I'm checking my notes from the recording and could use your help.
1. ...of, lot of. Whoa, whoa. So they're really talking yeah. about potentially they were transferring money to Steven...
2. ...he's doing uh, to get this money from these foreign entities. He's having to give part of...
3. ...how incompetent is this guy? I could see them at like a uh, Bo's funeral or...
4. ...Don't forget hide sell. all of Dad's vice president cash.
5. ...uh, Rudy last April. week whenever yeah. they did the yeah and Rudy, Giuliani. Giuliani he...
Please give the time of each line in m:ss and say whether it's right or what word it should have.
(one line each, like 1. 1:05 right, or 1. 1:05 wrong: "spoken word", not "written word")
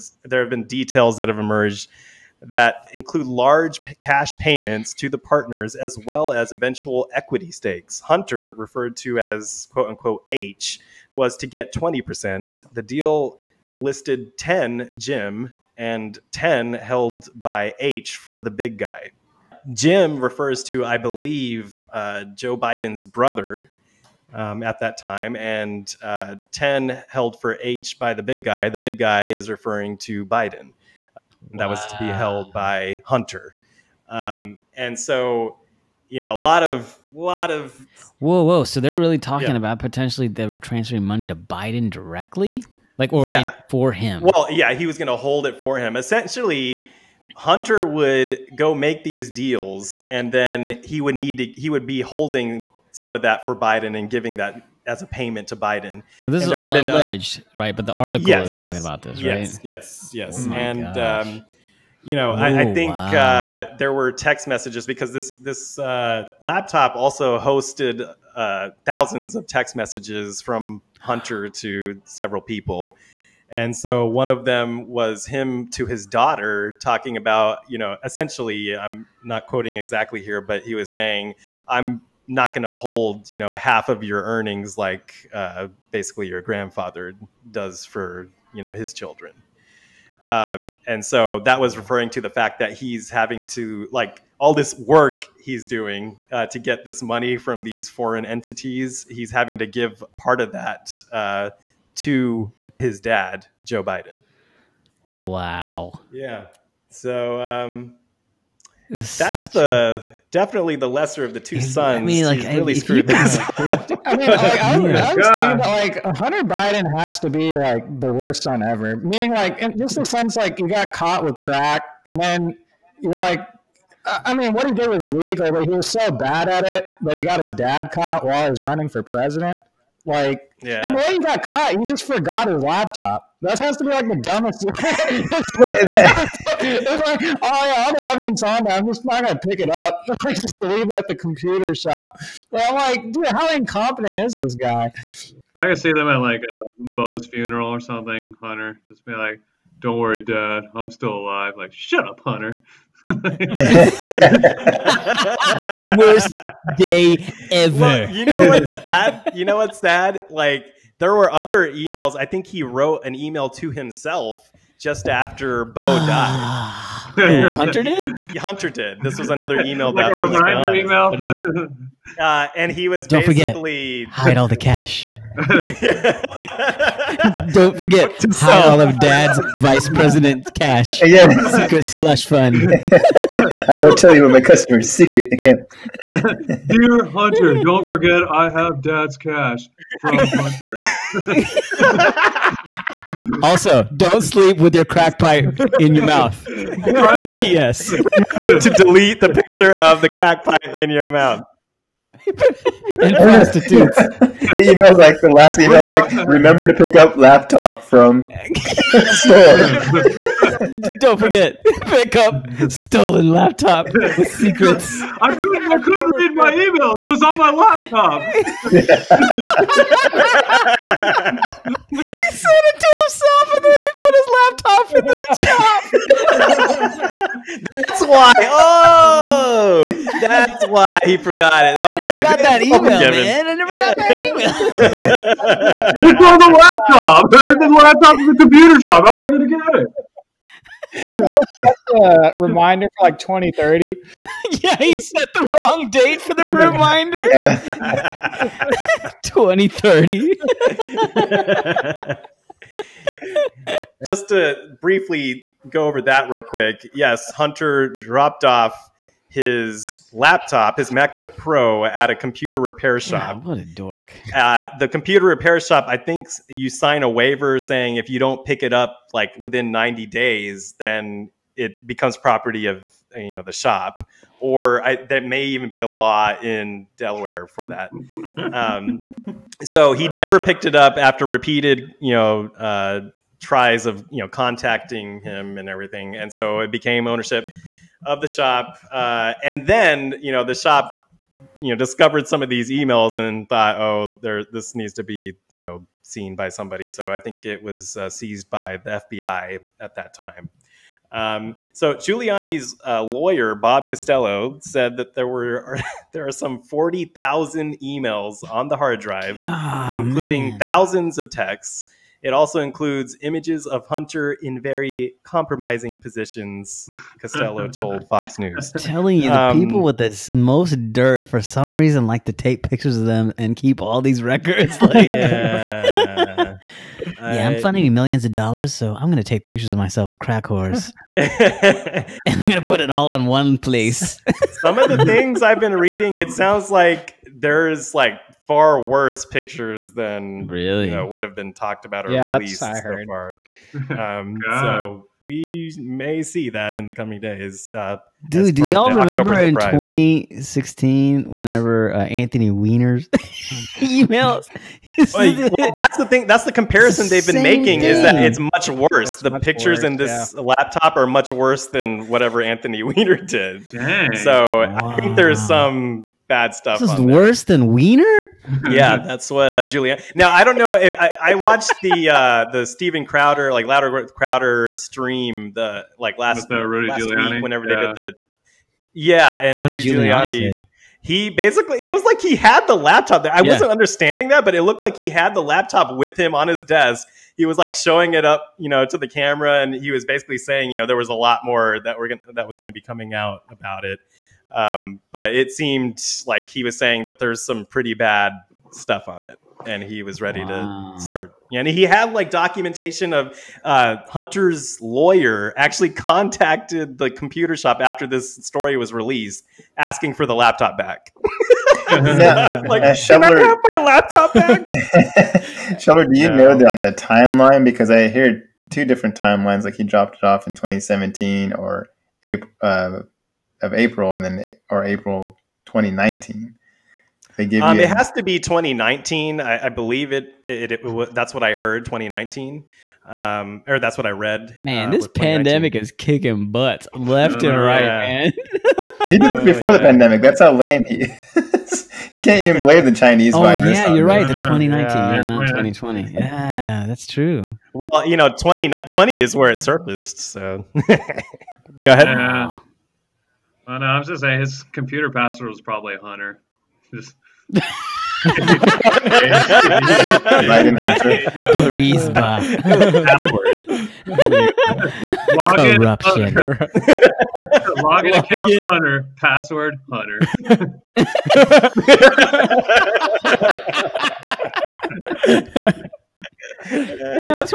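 1. 0:36 wrong: "Biden", not "Steven"
2. 1:35 right
3. 2:23 right
4. 2:57 right
5. 6:16 wrong: "Giuliani", not "April".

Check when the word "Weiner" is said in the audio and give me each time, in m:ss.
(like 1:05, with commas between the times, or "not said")
5:52, 6:02, 6:07.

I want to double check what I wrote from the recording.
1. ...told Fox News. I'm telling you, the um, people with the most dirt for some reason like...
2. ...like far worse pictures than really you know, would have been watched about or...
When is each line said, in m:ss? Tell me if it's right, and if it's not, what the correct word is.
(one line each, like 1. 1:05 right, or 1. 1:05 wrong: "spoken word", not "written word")
1. 5:17 right
2. 5:37 wrong: "talked", not "watched".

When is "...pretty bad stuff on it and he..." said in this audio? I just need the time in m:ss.
6:37.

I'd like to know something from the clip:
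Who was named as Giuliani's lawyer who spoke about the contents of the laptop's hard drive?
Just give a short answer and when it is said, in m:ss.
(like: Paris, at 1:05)
Bob Costello, at 5:03.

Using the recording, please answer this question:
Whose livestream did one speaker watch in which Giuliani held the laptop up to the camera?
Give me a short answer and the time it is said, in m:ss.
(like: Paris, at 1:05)
Steven Crowder, at 6:12.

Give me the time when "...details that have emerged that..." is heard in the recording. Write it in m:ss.
0:00.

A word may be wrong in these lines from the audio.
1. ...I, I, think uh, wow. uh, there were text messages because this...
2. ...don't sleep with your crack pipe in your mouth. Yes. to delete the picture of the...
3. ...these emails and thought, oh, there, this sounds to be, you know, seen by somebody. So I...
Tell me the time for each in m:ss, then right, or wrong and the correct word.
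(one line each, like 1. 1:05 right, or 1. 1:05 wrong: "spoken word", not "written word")
1. 1:02 right
2. 3:13 right
3. 4:52 wrong: "needs", not "sounds".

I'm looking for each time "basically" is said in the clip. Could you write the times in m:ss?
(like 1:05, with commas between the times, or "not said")
1:25, 2:53, 6:21, 6:30.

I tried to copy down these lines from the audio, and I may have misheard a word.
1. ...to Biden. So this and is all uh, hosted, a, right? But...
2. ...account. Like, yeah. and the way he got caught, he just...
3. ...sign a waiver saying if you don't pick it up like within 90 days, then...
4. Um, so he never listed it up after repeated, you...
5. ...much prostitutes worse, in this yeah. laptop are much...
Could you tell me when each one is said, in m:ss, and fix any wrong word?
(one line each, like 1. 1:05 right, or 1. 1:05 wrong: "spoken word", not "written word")
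1. 0:55 wrong: "alleged", not "hosted"
2. 2:09 wrong: "president", not "account"
3. 4:26 right
4. 4:38 wrong: "picked", not "listed"
5. 5:59 wrong: "pictures", not "prostitutes".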